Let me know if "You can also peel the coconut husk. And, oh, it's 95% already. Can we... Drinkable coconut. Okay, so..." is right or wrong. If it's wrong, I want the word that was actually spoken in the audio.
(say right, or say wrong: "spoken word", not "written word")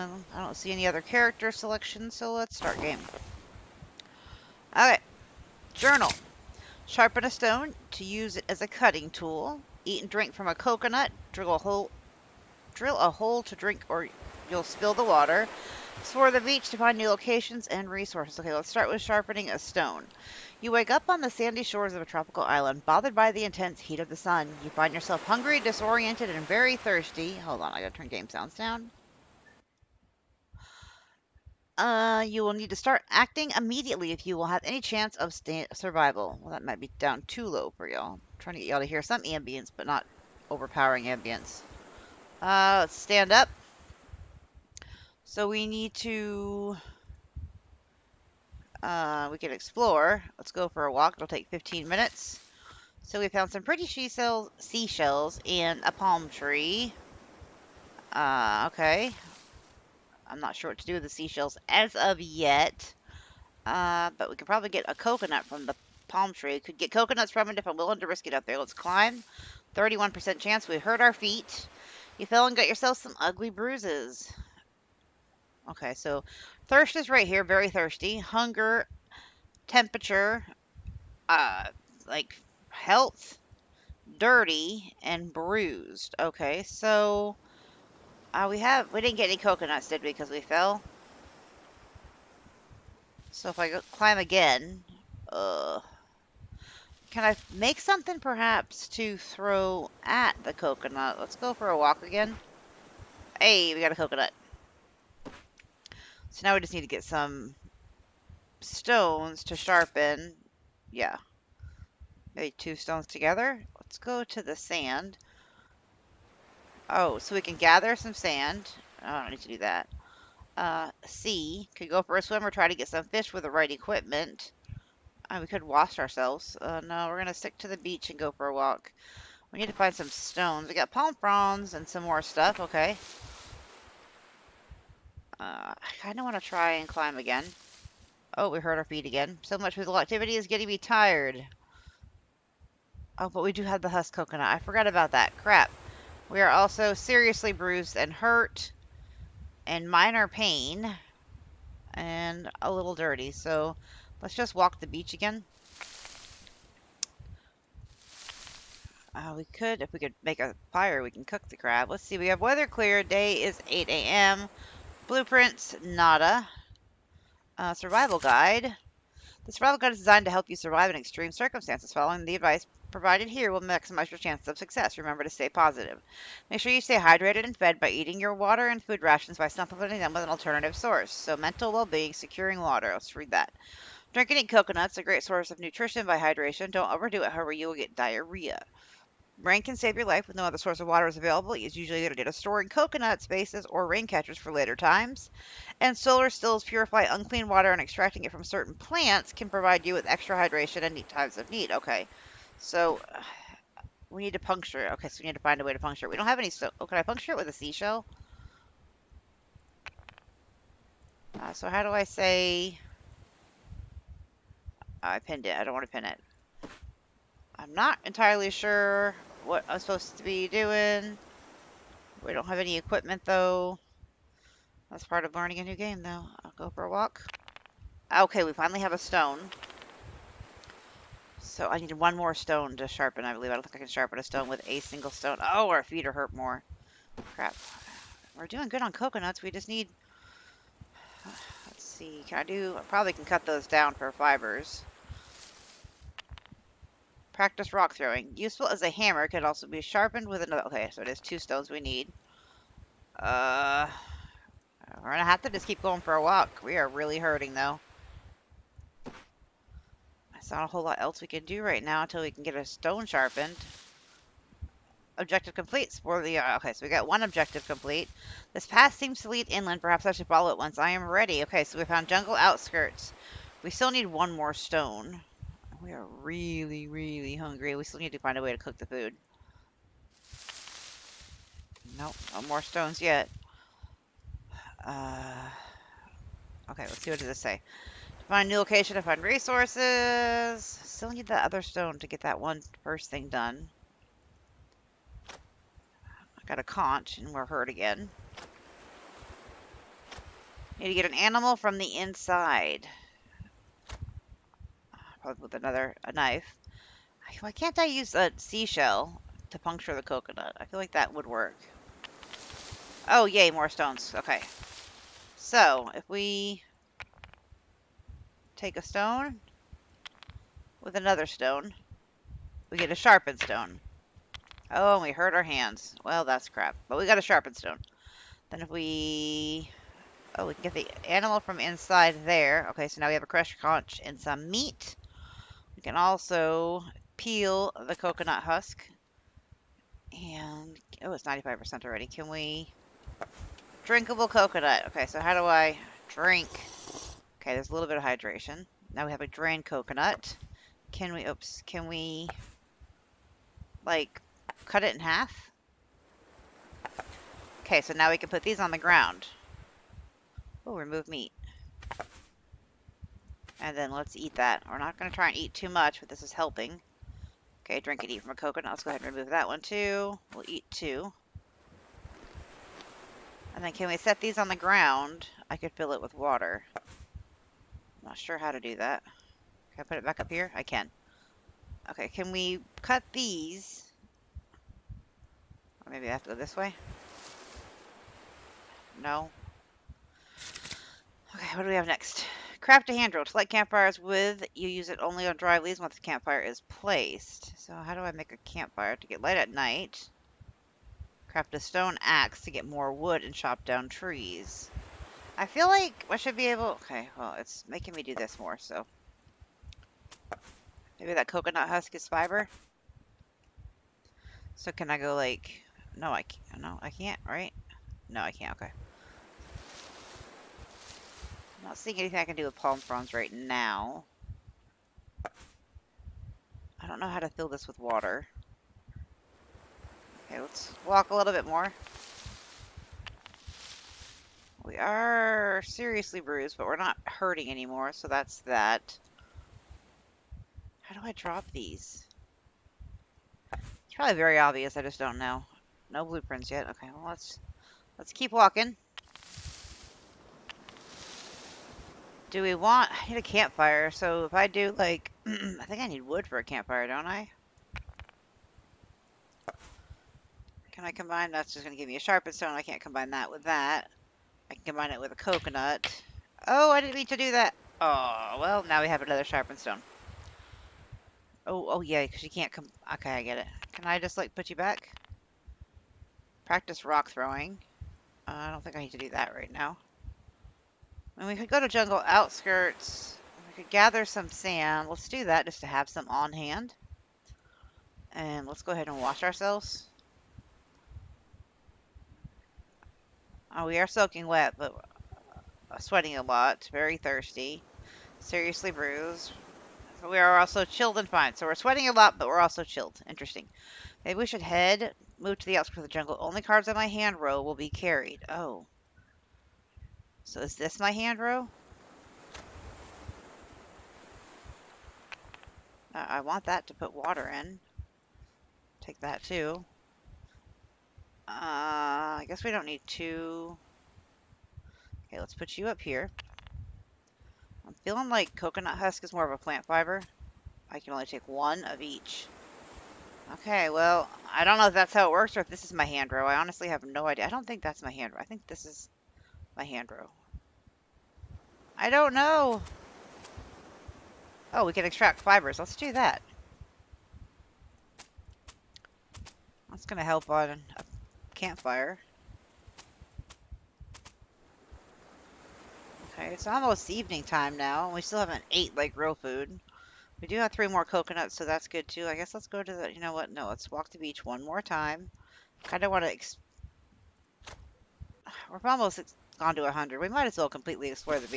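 right.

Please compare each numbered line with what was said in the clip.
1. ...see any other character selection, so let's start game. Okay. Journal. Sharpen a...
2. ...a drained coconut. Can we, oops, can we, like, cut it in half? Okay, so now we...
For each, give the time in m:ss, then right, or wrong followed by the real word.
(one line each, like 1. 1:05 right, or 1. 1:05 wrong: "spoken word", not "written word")
1. 0:00 right
2. 5:49 right.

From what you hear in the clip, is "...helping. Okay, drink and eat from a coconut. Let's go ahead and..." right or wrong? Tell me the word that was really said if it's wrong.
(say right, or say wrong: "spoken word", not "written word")
right.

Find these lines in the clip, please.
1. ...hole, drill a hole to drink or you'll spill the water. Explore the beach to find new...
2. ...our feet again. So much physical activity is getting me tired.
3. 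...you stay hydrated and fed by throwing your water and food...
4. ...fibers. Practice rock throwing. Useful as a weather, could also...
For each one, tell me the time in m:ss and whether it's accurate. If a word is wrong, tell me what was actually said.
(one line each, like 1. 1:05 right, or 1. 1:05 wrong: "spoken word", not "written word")
1. 0:11 right
2. 2:18 right
3. 2:56 wrong: "eating", not "throwing"
4. 4:04 wrong: "hammer", not "weather".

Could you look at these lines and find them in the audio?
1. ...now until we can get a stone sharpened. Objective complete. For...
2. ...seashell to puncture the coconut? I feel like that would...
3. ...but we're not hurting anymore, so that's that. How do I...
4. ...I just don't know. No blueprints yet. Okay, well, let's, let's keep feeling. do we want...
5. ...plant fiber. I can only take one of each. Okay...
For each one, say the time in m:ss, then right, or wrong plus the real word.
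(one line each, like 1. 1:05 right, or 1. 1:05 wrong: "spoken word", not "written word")
1. 4:21 right
2. 5:08 right
3. 7:16 right
4. 7:24 wrong: "walking", not "feeling"
5. 8:49 right.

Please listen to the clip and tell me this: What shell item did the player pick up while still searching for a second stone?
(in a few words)
a conch.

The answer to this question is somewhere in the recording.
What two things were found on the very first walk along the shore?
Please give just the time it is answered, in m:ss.
0:54.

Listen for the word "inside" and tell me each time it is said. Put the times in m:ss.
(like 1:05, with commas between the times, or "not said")
5:01, 5:31.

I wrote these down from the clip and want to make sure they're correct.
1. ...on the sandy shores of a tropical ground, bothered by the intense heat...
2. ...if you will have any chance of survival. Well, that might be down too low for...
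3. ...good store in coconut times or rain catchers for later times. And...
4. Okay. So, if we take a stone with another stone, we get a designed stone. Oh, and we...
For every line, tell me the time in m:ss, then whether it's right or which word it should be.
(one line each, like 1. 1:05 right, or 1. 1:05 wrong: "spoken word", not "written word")
1. 0:21 wrong: "island", not "ground"
2. 0:34 right
3. 3:12 wrong: "spaces", not "times"
4. 5:14 wrong: "sharpened", not "designed".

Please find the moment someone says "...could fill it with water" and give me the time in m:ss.
6:15.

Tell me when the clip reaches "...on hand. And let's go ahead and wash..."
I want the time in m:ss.
8:06.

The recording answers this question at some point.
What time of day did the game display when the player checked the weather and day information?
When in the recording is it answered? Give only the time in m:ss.
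2:43.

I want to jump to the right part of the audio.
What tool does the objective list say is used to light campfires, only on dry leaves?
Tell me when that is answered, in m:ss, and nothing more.
6:32.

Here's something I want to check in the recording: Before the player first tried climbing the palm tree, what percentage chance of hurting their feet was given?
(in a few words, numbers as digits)
31%.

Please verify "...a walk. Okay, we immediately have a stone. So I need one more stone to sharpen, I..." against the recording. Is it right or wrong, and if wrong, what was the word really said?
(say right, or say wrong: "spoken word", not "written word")
wrong: "finally", not "immediately".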